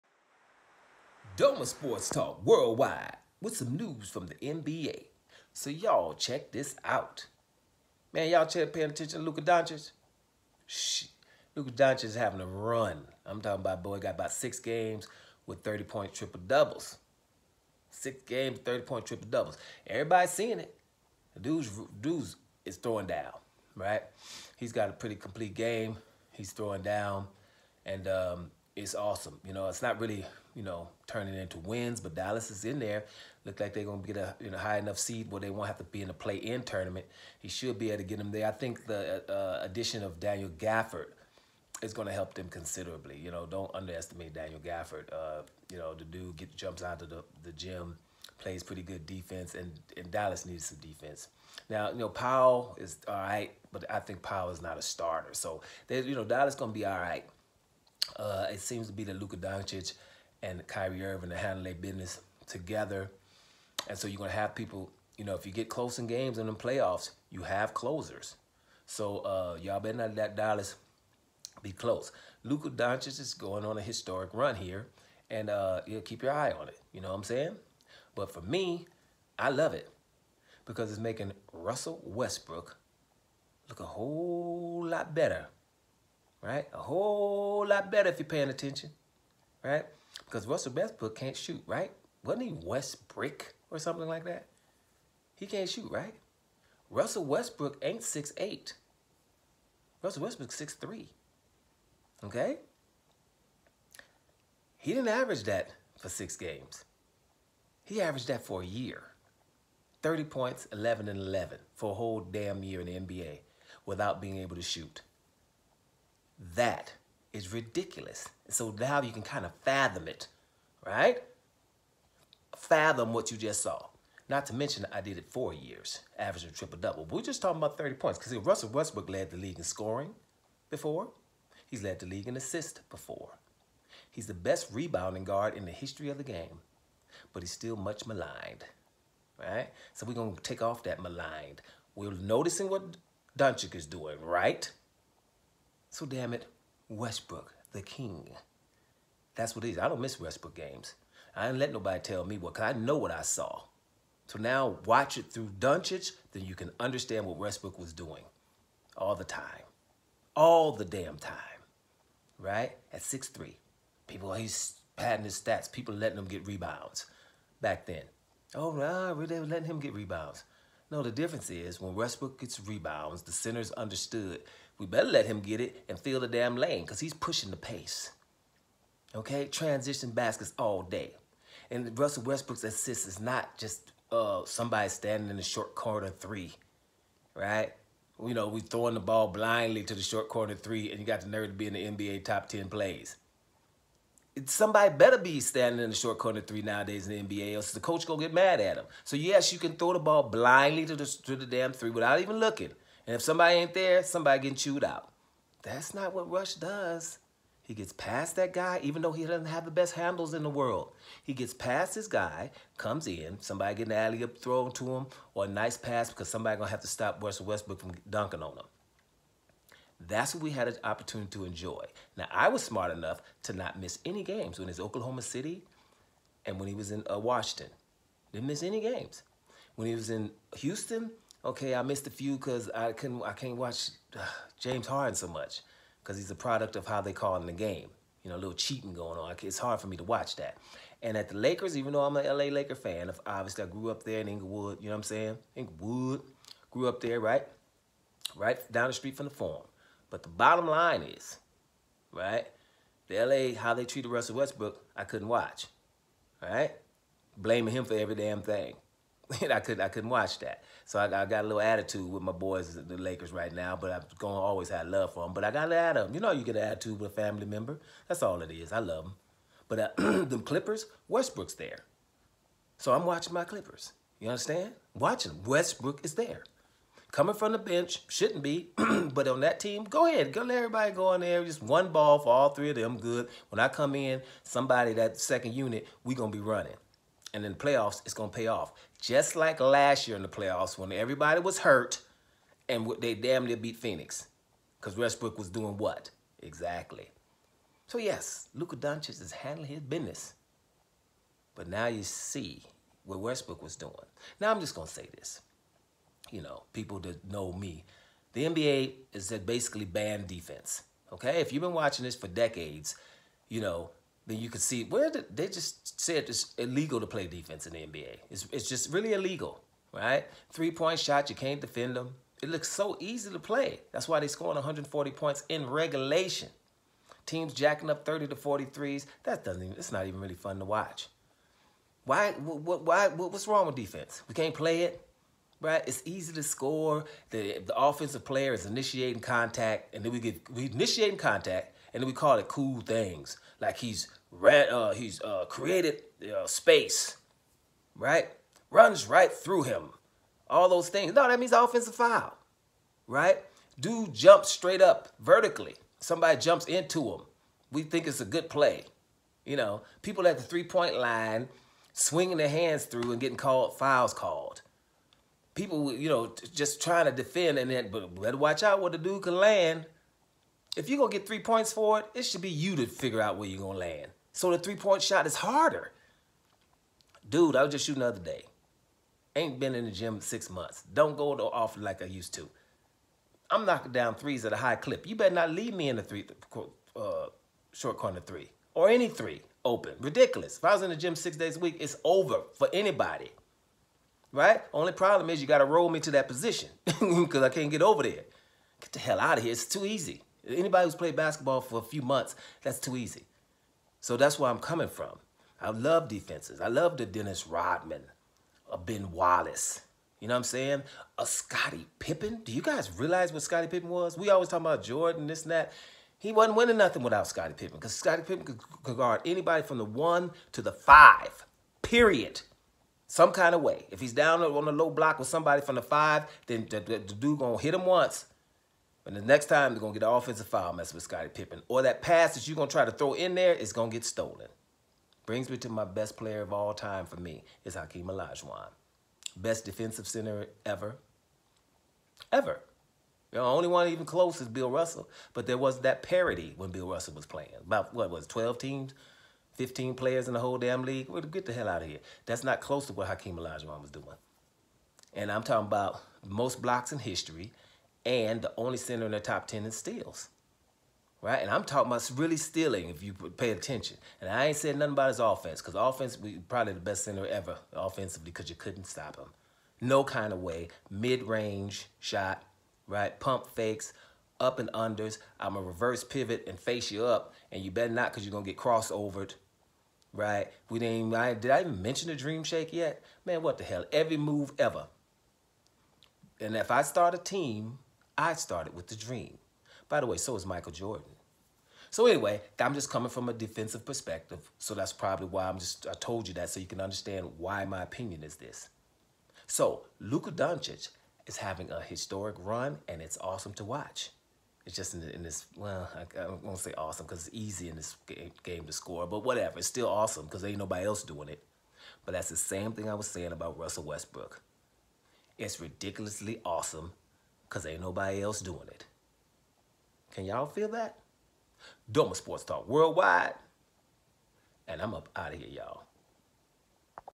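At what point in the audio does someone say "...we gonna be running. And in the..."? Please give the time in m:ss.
4:46.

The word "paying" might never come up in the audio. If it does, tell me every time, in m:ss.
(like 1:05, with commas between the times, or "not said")
0:08, 1:28.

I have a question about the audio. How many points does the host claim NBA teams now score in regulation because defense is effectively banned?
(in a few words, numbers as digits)
140.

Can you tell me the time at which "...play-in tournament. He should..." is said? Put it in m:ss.
0:36.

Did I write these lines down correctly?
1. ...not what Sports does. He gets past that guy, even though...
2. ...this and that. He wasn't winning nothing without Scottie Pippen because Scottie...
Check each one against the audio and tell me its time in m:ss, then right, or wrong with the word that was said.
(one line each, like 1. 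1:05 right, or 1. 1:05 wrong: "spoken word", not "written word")
1. 3:25 wrong: "Russ", not "Sports"
2. 6:55 right.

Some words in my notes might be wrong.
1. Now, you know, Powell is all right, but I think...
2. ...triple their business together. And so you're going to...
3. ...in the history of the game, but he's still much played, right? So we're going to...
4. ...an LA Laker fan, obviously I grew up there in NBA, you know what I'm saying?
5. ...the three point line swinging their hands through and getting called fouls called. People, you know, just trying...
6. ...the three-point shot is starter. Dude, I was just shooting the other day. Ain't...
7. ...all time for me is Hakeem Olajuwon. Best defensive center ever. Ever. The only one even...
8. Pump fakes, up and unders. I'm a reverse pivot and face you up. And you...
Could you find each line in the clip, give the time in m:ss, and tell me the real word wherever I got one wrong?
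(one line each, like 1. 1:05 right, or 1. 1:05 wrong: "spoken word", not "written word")
1. 0:51 right
2. 1:01 wrong: "handle", not "triple"
3. 2:15 wrong: "maligned", not "played"
4. 4:02 wrong: "Inglewood", not "NBA"
5. 6:00 right
6. 6:14 wrong: "harder", not "starter"
7. 7:16 right
8. 7:53 right.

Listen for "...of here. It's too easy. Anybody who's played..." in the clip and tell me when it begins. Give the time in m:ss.
6:39.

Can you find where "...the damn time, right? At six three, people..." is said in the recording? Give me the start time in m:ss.
2:40.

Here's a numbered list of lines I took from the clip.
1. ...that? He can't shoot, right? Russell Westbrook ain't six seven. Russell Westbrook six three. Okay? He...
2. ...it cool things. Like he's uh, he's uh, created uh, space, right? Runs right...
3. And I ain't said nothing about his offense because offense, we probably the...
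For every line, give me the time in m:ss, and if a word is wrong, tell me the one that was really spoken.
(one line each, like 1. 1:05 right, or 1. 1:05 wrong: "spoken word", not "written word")
1. 1:34 wrong: "eight", not "seven"
2. 5:42 right
3. 7:44 right.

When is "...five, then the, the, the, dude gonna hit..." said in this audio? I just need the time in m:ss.
7:05.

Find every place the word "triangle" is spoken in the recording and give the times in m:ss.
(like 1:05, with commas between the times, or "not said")
not said.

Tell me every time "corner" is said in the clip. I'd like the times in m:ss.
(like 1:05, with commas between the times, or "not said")
3:05, 3:10, 3:16, 6:27.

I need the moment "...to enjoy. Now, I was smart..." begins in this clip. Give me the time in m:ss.
3:41.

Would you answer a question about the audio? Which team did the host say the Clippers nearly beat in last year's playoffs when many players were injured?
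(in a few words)
Phoenix.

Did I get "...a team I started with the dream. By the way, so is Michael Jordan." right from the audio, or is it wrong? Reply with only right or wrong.
right.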